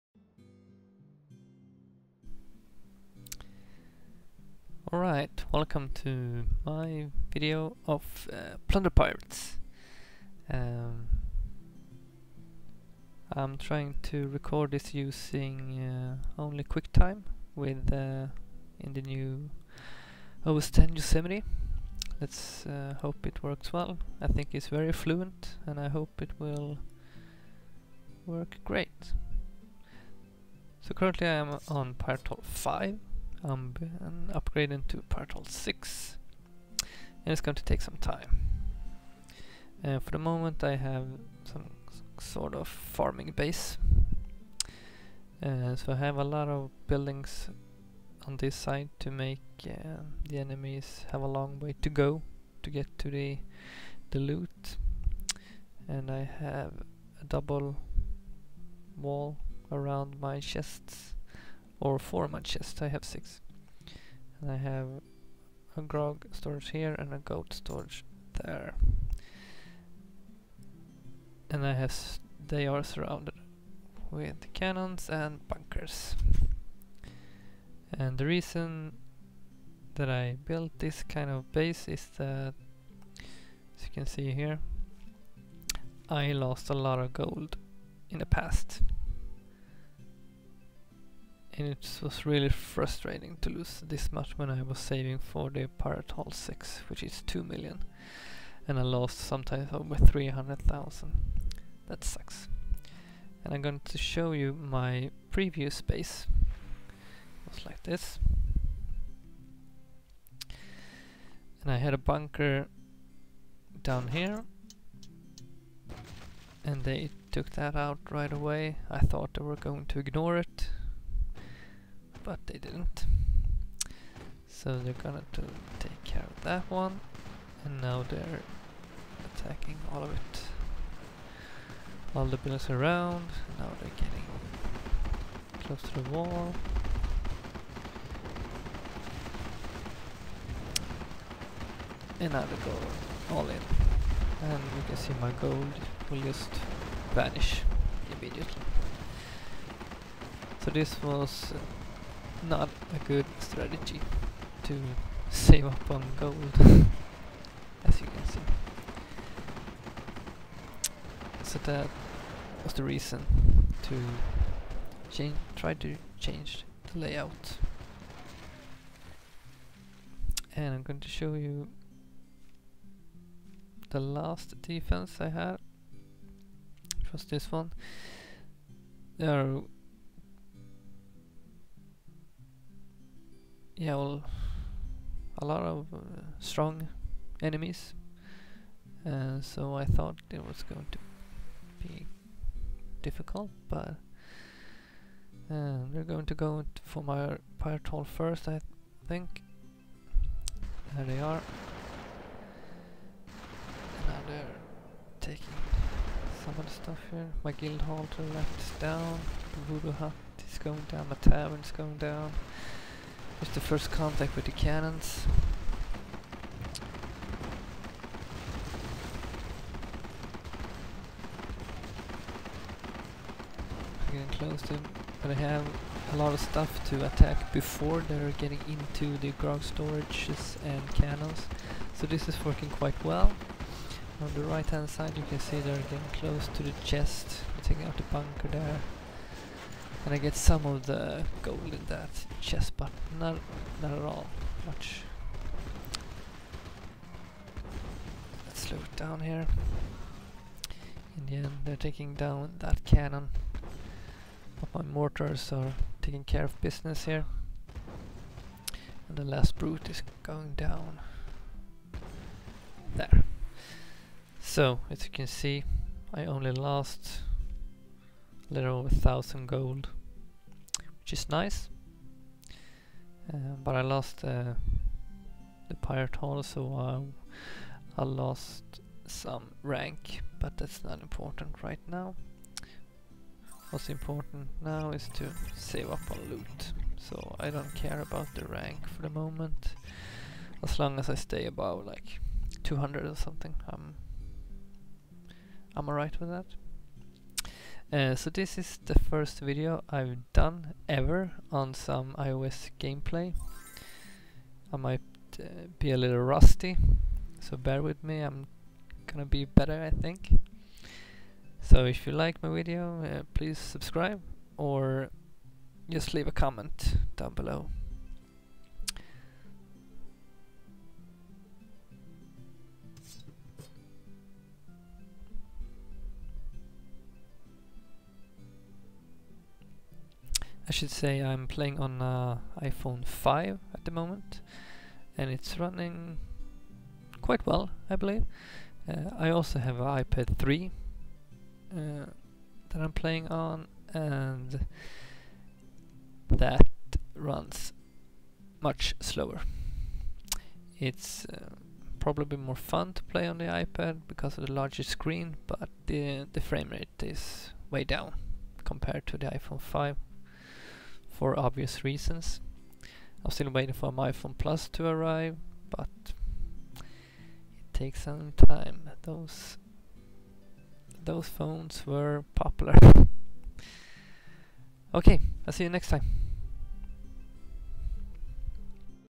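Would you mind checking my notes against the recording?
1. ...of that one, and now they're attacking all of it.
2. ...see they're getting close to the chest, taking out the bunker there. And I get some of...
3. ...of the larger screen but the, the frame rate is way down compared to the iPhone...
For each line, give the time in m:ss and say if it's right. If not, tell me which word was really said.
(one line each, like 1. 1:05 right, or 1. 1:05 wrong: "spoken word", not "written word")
1. 2:06 right
2. 3:55 right
3. 5:54 right.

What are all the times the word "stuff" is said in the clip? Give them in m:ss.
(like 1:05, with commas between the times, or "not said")
3:26, 3:46.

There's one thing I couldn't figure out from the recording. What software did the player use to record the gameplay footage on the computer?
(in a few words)
QuickTime.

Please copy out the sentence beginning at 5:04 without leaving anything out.
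I might uh, be a little rusty, so bear with me, I'm gonna be better I think.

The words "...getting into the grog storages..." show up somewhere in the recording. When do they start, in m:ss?
3:48.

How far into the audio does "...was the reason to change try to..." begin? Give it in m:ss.
2:42.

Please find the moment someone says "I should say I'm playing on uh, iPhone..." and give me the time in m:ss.
5:30.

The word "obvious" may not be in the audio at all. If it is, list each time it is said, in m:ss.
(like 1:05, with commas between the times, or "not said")
6:01.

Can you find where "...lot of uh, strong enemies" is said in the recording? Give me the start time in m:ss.
3:05.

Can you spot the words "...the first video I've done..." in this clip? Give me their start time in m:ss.
4:58.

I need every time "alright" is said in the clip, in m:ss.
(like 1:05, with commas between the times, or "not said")
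0:04, 4:55.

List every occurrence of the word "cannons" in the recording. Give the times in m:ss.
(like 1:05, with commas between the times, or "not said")
1:14, 3:34, 3:50, 4:12.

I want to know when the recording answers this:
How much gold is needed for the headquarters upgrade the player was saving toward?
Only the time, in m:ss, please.
1:37.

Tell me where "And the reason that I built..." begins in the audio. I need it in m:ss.
1:17.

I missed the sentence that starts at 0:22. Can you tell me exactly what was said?
Let's uh, hope it works well.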